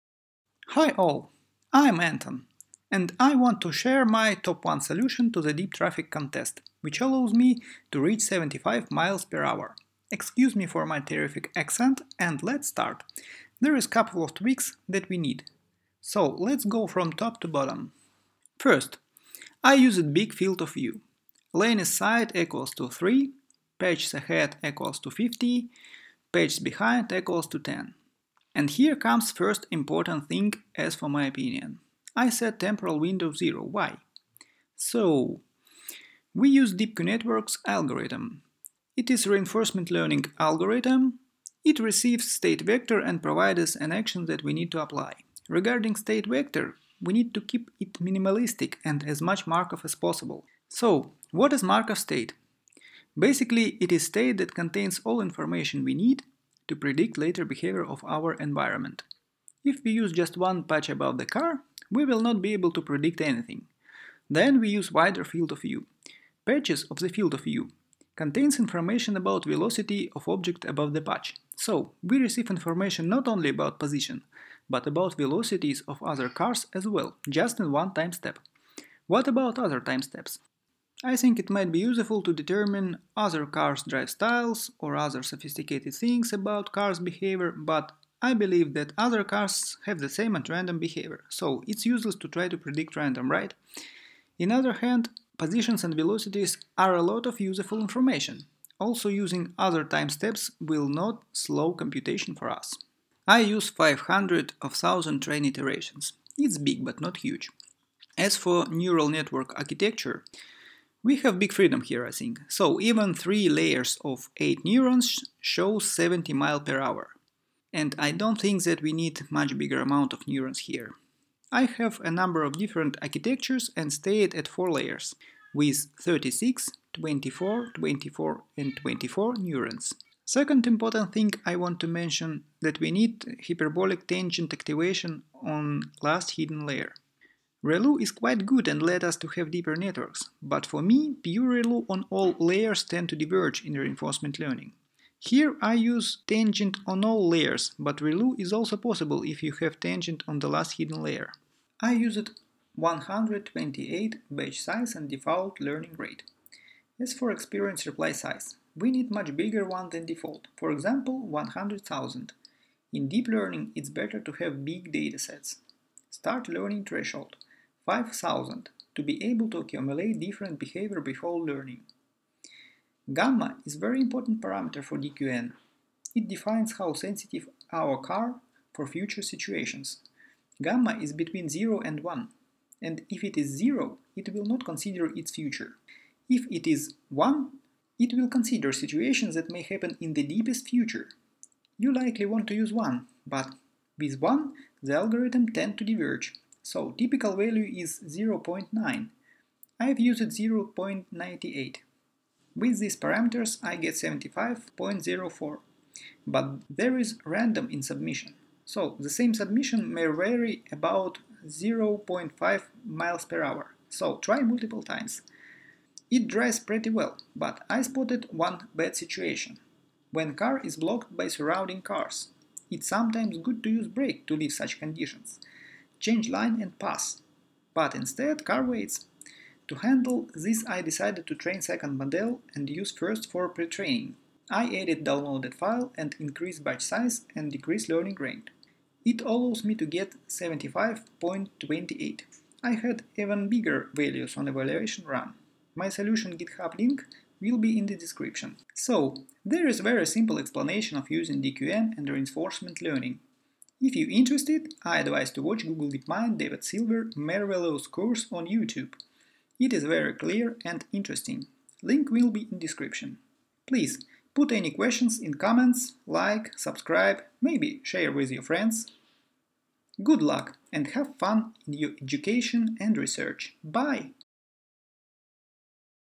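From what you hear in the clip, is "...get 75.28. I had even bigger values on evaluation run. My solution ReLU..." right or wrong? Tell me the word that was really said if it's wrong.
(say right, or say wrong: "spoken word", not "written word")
wrong: "GitHub", not "ReLU".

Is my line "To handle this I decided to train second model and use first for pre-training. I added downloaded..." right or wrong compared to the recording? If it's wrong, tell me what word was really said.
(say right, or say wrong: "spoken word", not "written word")
right.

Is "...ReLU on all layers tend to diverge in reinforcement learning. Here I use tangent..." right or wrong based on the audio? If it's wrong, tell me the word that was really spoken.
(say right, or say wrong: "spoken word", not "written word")
right.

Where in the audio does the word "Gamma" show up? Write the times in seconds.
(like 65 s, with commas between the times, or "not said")
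173 s, 180 s.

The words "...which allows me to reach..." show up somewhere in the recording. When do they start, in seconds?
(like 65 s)
6 s.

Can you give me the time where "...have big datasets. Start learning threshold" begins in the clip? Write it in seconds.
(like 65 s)
164 s.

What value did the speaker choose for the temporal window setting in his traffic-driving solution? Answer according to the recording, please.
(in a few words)
0.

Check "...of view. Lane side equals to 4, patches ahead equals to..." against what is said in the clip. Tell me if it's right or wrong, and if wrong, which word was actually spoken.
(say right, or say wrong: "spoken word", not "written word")
wrong: "3", not "4".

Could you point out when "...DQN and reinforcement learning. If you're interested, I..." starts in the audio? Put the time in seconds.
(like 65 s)
251 s.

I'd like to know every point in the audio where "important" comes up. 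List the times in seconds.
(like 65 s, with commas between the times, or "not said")
29 s, 130 s, 173 s.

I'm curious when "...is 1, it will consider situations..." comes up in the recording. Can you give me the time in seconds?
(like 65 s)
186 s.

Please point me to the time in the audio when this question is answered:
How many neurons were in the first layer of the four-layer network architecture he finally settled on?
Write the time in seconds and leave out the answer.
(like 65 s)
126 s.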